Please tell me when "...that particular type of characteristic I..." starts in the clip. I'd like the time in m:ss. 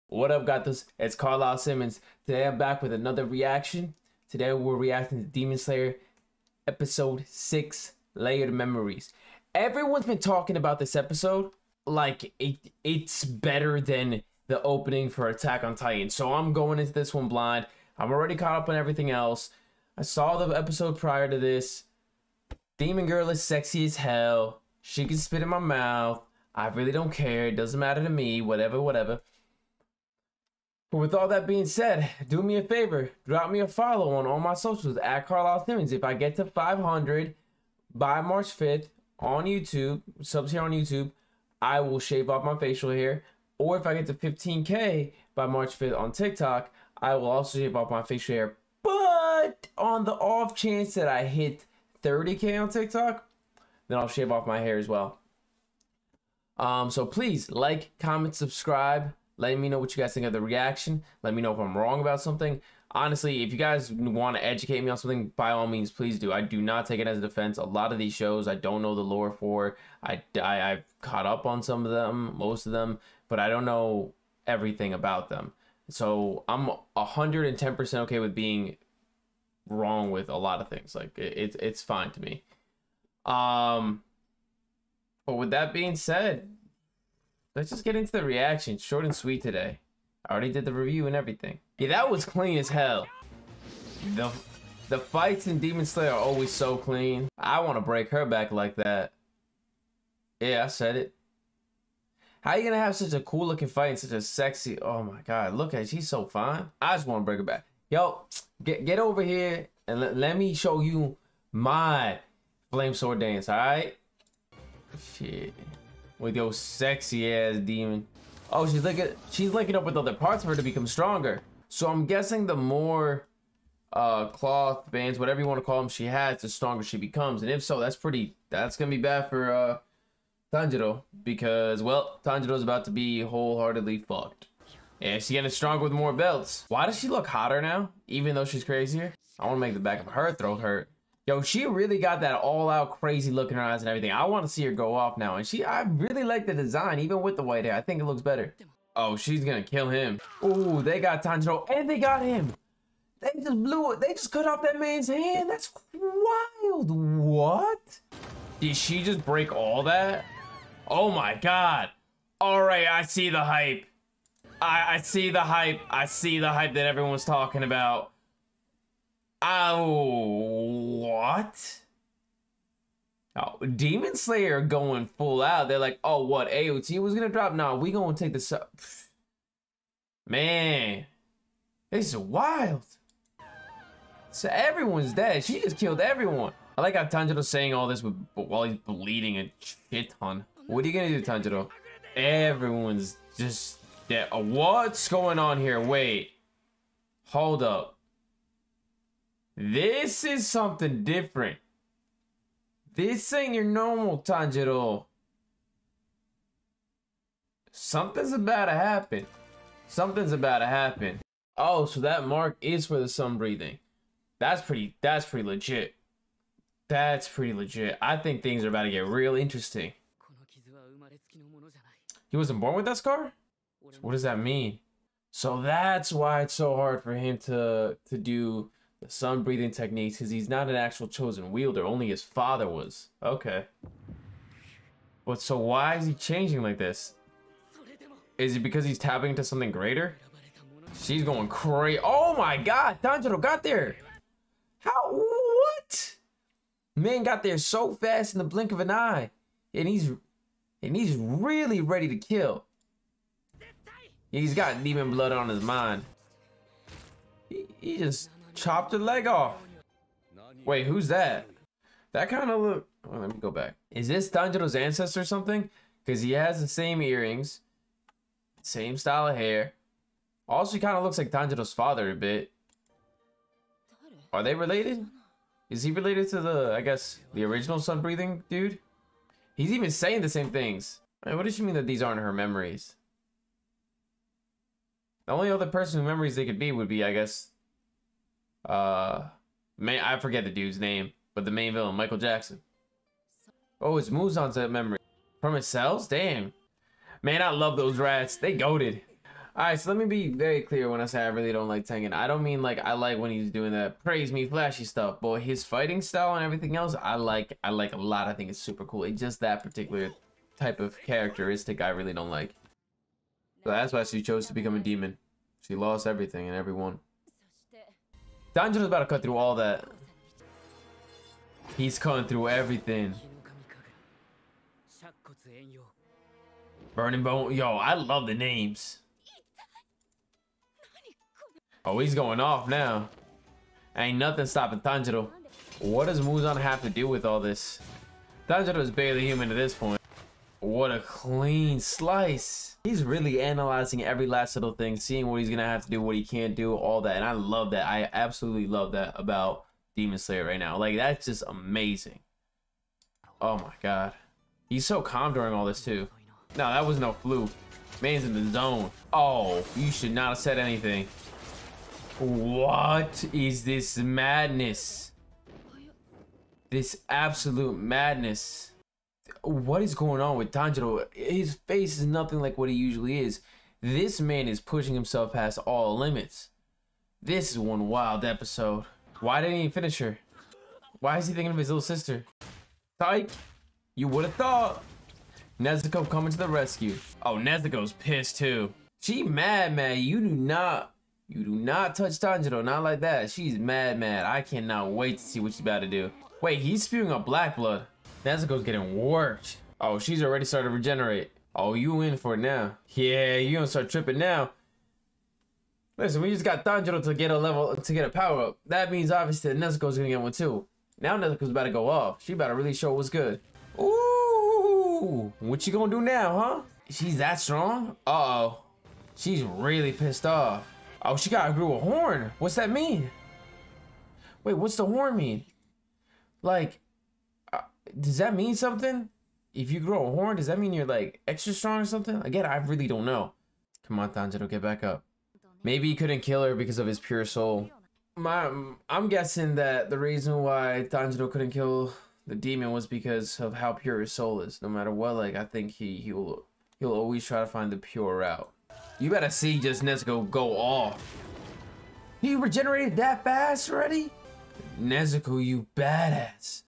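5:09.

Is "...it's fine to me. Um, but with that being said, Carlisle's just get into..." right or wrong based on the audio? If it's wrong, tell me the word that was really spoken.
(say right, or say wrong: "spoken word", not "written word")
wrong: "Let", not "Carlisle".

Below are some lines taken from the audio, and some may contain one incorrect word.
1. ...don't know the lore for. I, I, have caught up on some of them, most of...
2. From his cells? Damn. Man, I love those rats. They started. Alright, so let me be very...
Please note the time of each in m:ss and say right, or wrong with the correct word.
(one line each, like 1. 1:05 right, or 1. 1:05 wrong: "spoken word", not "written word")
1. 1:08 right
2. 4:55 wrong: "goaded", not "started".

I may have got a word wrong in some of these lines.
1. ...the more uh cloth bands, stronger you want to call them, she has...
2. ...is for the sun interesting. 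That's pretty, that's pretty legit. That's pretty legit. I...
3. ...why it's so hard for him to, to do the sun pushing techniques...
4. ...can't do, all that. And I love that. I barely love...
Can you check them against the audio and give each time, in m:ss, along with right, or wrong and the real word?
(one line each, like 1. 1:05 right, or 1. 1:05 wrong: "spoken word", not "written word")
1. 2:02 wrong: "whatever", not "stronger"
2. 3:32 wrong: "breathing", not "interesting"
3. 3:46 wrong: "breathing", not "pushing"
4. 5:46 wrong: "absolutely", not "barely".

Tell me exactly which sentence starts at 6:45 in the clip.
Listen, we just got Tanjiro to get a level, to get a power up.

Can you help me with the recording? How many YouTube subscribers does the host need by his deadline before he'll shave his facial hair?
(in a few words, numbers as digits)
500.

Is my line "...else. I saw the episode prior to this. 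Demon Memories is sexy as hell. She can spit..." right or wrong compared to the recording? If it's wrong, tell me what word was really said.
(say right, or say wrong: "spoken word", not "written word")
wrong: "Girl", not "Memories".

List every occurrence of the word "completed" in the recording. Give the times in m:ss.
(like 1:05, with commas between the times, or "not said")
not said.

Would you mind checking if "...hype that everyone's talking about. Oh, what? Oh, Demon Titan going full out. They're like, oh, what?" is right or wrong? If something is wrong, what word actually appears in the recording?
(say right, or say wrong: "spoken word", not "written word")
wrong: "Slayer", not "Titan".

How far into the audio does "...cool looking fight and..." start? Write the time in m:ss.
1:43.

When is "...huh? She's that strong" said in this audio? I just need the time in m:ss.
6:56.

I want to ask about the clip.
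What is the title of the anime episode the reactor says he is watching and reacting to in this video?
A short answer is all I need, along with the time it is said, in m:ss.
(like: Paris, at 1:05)
Layered Memories, at 0:08.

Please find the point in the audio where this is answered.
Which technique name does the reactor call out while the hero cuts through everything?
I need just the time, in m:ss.
5:26.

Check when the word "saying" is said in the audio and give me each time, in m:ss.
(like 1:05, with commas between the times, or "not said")
3:07, 4:39.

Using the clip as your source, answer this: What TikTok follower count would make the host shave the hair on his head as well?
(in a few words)
30K.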